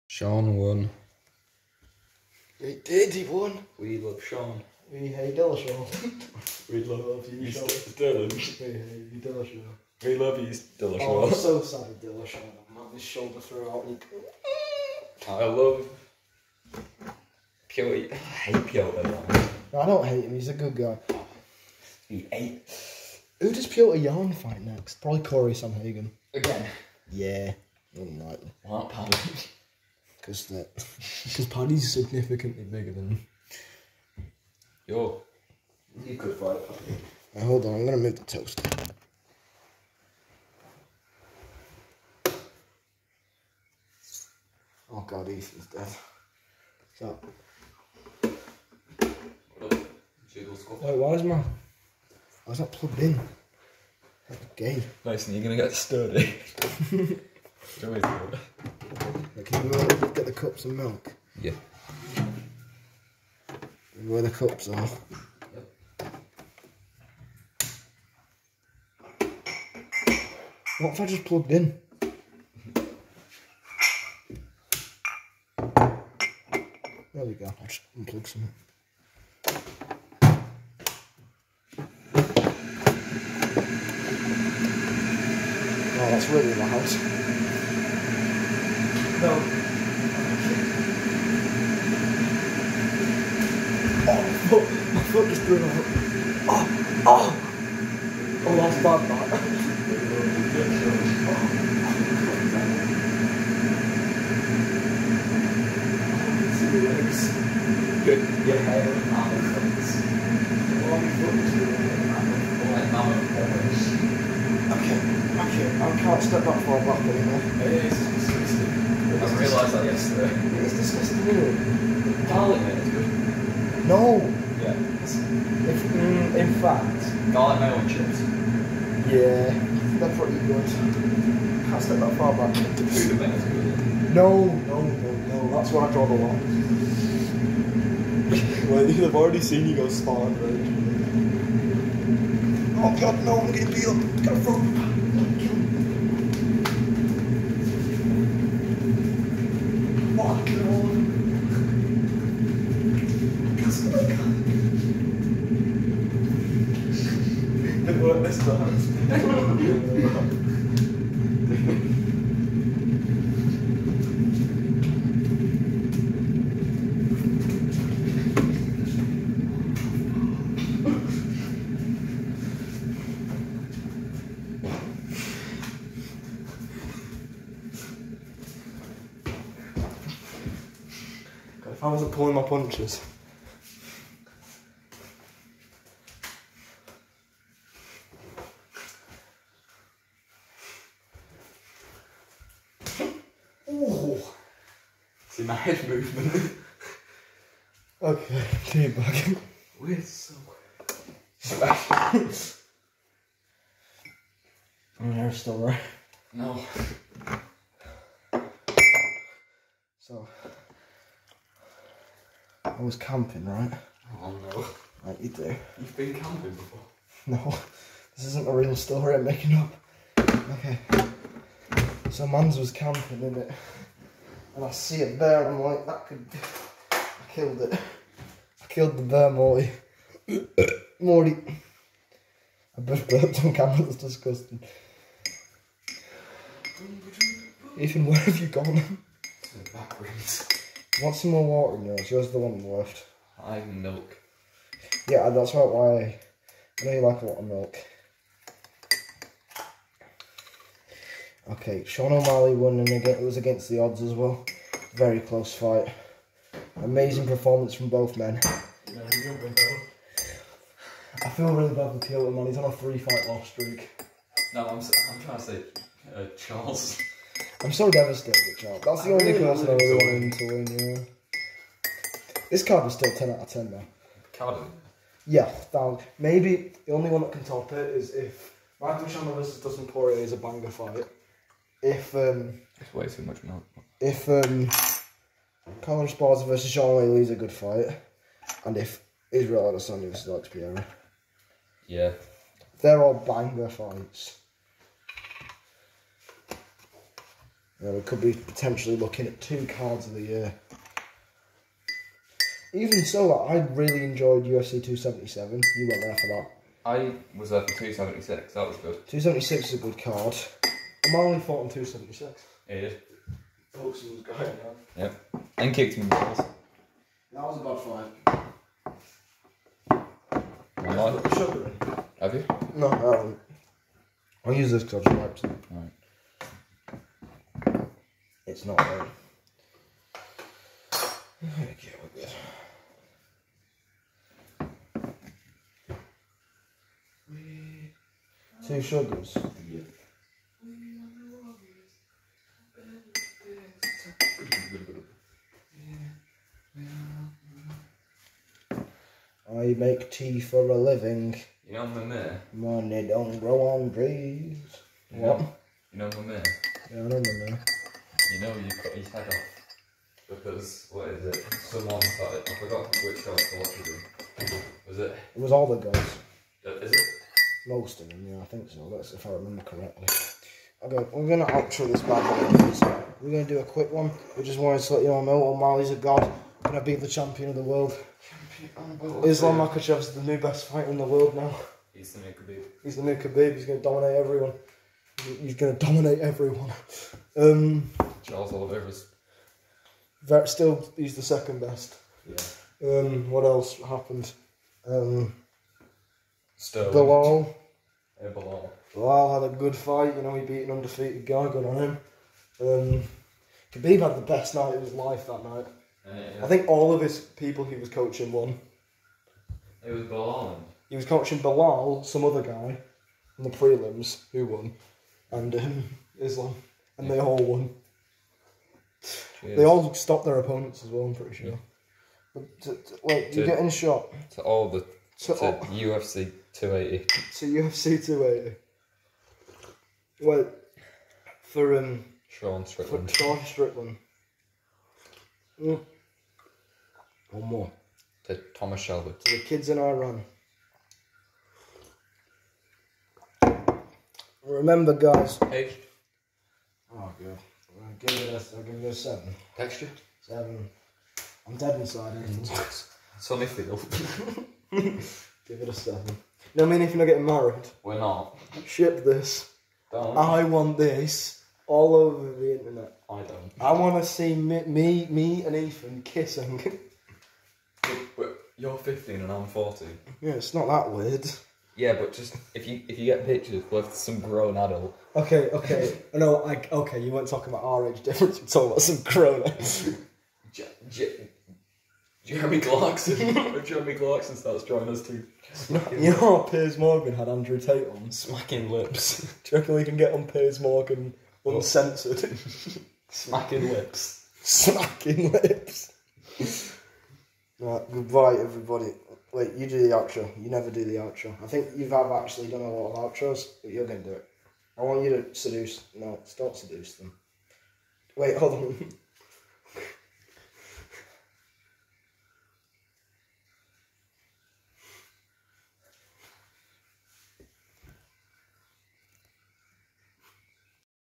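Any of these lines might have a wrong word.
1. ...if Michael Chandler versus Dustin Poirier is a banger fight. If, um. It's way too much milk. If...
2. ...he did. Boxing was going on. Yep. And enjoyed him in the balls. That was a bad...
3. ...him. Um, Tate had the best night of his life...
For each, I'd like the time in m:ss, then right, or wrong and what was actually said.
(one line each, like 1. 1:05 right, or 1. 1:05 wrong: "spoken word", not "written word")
1. 4:38 right
2. 5:12 wrong: "kicked", not "enjoyed"
3. 6:41 wrong: "Khabib", not "Tate".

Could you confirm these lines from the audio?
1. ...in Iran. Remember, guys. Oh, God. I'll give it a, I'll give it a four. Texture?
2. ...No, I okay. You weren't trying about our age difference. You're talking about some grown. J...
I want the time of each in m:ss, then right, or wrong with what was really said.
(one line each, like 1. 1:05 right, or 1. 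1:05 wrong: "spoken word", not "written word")
1. 7:19 wrong: "seven", not "four"
2. 7:56 wrong: "talking", not "trying".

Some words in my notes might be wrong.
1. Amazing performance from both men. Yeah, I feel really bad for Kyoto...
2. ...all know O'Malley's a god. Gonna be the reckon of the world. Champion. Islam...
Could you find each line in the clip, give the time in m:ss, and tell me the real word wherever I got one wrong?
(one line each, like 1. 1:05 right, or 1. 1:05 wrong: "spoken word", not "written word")
1. 4:16 right
2. 6:15 wrong: "champion", not "reckon".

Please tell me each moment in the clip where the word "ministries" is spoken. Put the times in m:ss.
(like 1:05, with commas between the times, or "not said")
not said.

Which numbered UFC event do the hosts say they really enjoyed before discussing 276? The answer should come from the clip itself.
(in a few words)
UFC 277.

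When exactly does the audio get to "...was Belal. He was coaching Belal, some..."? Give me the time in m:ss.
6:49.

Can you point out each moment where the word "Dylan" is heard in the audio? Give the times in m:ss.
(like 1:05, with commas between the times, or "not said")
0:07.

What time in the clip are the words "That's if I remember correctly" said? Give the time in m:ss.
6:08.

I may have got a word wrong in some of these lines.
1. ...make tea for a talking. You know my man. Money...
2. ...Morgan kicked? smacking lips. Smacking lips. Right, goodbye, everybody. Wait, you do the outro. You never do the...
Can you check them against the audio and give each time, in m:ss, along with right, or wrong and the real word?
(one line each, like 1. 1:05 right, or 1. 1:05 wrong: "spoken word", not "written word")
1. 5:49 wrong: "living", not "talking"
2. 8:10 wrong: "uncensored", not "kicked".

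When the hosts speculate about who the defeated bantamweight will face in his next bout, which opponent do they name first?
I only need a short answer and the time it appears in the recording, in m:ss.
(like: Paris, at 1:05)
Cory Sandhagen, at 0:25.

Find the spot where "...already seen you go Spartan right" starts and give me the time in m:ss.
2:19.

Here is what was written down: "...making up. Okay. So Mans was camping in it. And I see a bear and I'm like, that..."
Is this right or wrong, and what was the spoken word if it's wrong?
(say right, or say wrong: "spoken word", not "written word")
right.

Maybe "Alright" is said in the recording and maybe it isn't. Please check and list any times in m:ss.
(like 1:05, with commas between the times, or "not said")
5:25.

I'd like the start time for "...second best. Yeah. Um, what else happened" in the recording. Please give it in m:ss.
6:31.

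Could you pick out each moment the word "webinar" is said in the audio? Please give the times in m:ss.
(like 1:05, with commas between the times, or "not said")
not said.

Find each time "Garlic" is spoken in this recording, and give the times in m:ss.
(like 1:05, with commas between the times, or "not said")
2:02, 2:07.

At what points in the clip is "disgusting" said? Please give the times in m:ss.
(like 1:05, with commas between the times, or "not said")
2:00, 3:53.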